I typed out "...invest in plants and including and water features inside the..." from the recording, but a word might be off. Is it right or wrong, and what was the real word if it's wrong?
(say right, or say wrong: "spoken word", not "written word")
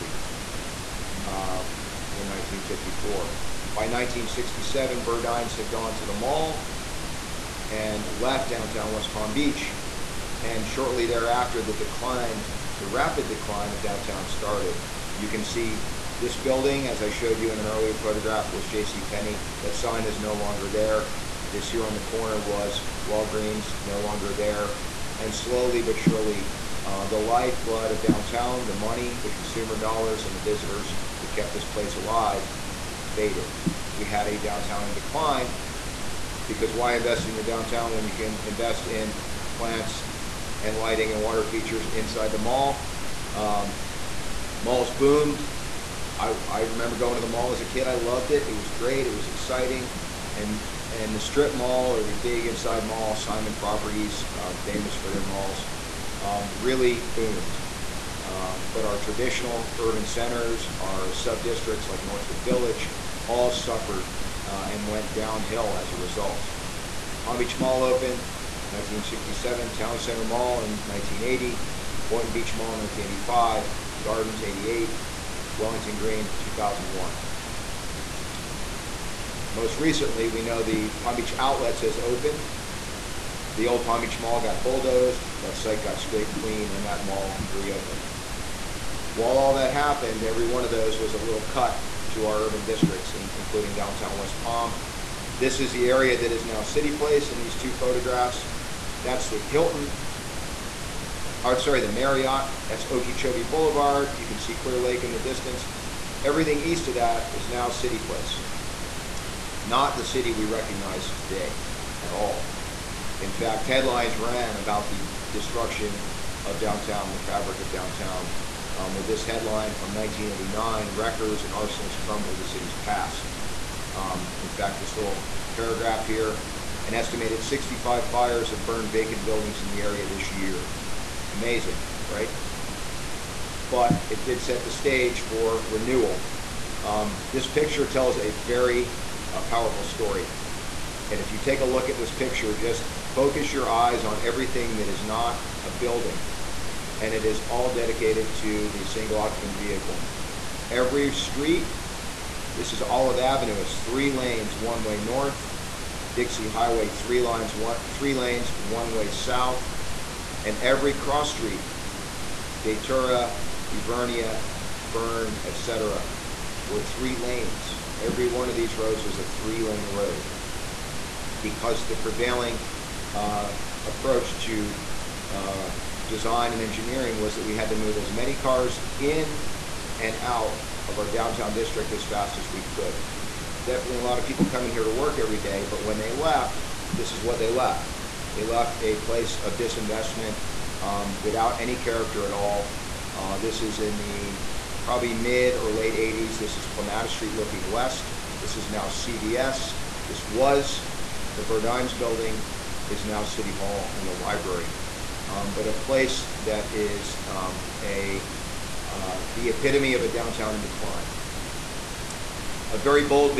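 wrong: "lighting", not "including".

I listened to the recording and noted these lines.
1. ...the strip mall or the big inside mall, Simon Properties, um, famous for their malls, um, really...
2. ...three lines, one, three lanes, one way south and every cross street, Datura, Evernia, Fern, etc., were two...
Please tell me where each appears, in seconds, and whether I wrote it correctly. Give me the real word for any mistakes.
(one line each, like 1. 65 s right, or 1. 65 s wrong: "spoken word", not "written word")
1. 51 s right
2. 156 s wrong: "three", not "two".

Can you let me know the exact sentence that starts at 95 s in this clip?
This is the area that is now City Place in these two photographs.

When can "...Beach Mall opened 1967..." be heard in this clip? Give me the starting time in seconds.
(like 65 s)
67 s.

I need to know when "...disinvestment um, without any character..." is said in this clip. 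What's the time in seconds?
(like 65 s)
189 s.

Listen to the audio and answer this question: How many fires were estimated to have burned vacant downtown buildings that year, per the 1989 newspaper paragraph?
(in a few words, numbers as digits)
65.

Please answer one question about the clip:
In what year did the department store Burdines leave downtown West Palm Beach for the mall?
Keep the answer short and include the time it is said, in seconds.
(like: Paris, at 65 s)
1967, at 3 s.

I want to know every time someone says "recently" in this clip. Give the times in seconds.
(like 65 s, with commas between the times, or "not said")
79 s.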